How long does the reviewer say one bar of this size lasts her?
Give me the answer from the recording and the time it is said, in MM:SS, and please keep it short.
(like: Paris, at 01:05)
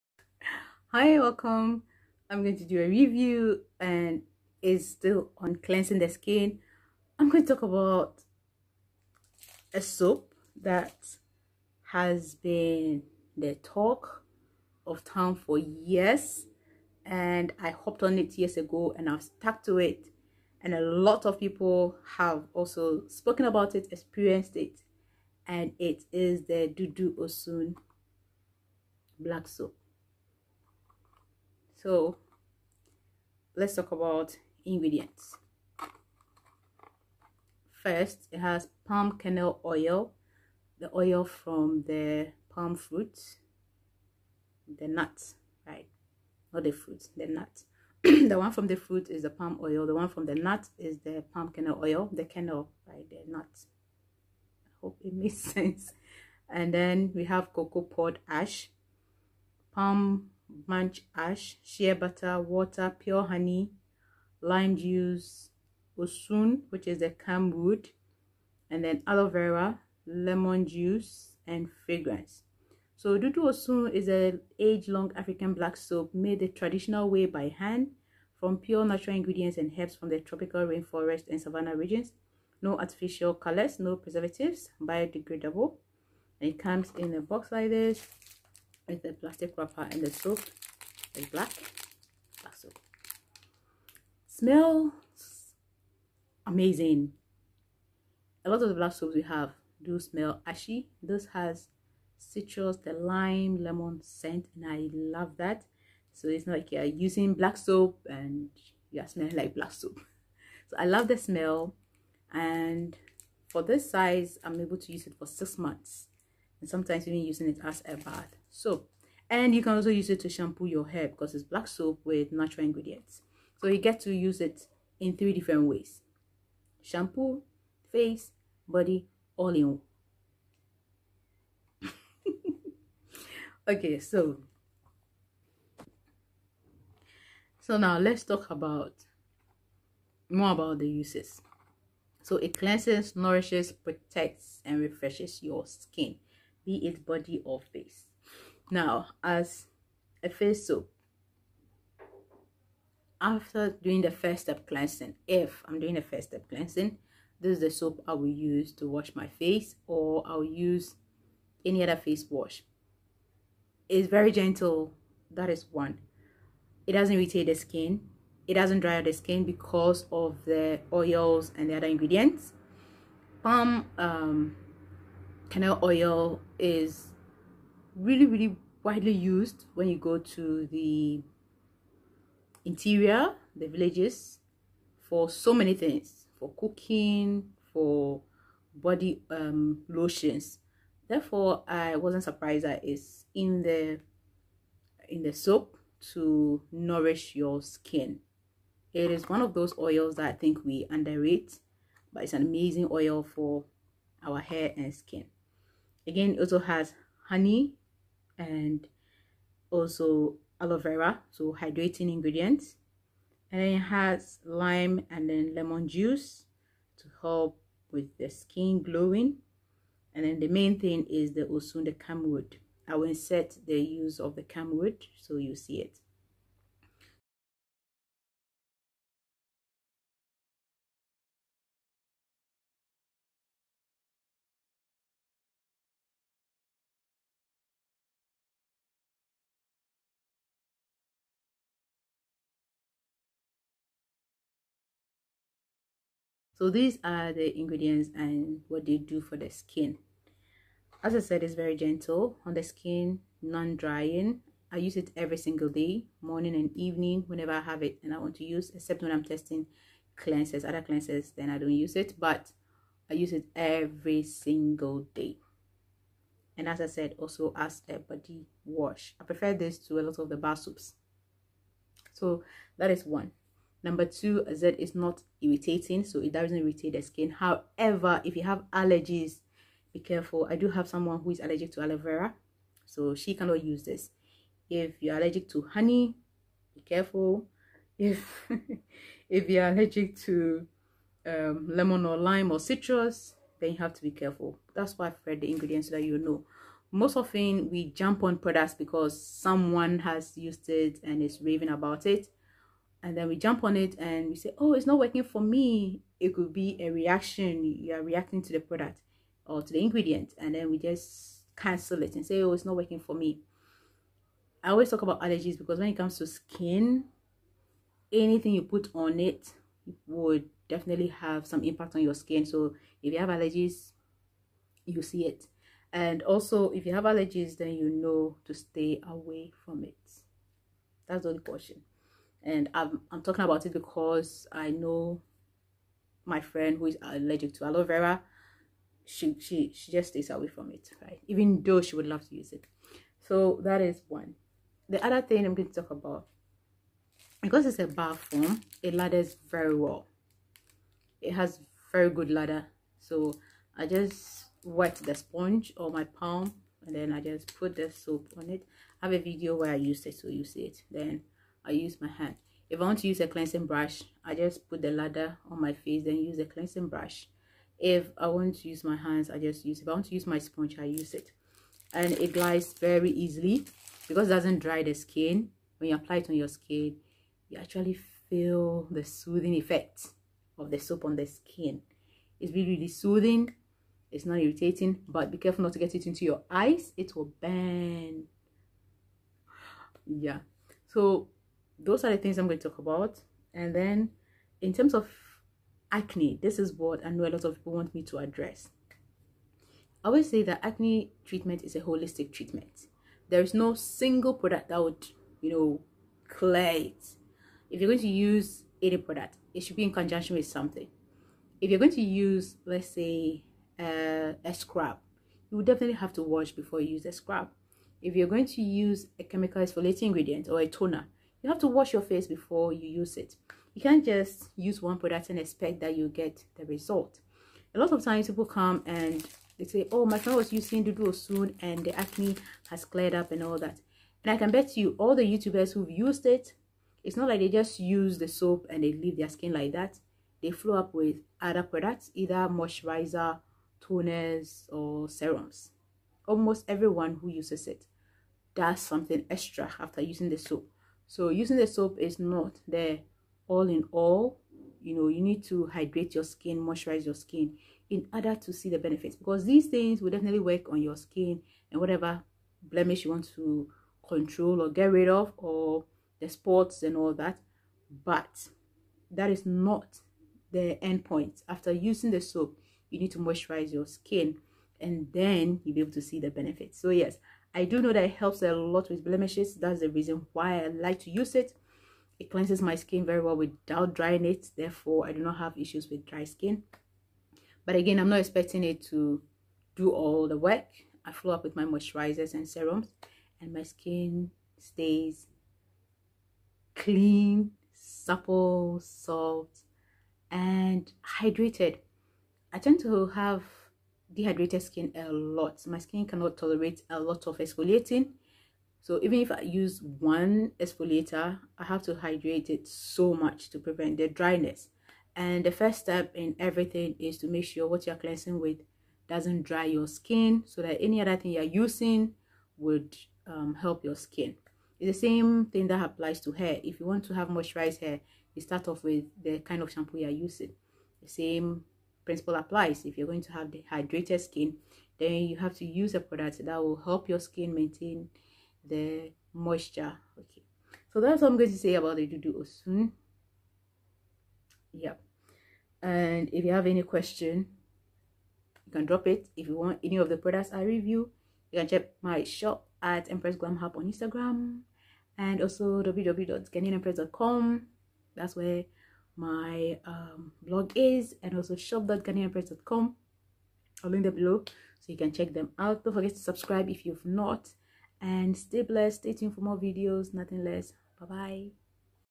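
6 months, at 01:55.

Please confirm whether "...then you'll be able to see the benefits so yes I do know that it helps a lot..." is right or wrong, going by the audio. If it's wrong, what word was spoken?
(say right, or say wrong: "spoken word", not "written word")
right.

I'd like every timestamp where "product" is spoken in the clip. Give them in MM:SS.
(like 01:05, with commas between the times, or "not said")
04:58, 05:08, 06:44, 06:48, 07:04, 07:21, 08:55, 09:10.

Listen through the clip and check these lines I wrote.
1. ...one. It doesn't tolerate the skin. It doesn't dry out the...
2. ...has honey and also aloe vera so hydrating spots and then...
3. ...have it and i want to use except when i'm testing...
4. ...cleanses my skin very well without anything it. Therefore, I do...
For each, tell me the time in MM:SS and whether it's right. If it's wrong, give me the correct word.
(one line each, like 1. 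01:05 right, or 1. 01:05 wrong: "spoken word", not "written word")
1. 02:45 wrong: "irritate", not "tolerate"
2. 03:26 wrong: "ingredients", not "spots"
3. 04:17 right
4. 08:02 wrong: "drying", not "anything".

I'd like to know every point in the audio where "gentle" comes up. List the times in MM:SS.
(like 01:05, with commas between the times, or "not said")
02:44, 04:11.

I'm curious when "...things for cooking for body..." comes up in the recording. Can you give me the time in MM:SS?
03:05.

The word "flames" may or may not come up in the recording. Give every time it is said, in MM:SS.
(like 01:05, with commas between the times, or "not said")
not said.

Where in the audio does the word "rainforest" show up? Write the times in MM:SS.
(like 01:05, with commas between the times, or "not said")
01:20.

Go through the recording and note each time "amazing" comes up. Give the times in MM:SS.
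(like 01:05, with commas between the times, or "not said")
01:36, 03:22.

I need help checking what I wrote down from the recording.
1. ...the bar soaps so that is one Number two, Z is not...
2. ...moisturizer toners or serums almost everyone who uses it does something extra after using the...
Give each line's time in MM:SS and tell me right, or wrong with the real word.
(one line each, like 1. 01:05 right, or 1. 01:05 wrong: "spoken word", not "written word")
1. 04:30 right
2. 07:22 right.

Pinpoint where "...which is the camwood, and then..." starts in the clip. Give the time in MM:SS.
01:06.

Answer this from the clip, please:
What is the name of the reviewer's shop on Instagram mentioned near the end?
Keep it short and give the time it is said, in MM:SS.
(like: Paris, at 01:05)
Empress Glam Hub, at 09:13.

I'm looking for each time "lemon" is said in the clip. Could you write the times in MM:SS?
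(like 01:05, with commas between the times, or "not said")
01:10, 01:43, 03:35, 04:51.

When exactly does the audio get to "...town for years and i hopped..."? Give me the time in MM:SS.
00:15.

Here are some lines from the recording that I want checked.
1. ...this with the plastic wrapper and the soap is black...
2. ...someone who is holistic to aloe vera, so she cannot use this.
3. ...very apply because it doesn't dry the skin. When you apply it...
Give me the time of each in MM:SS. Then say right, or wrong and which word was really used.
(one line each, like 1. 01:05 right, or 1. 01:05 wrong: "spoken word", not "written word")
1. 01:27 right
2. 04:40 wrong: "allergic", not "holistic"
3. 06:12 wrong: "easily", not "apply".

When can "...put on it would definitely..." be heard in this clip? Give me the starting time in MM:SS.
05:18.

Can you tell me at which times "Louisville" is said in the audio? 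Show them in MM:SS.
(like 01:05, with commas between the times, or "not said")
not said.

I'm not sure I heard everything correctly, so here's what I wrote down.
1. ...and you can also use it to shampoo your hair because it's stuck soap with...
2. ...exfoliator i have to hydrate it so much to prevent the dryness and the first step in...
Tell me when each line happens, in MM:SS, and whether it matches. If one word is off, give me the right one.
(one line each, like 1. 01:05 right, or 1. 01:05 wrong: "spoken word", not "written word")
1. 01:59 wrong: "black", not "stuck"
2. 08:30 right.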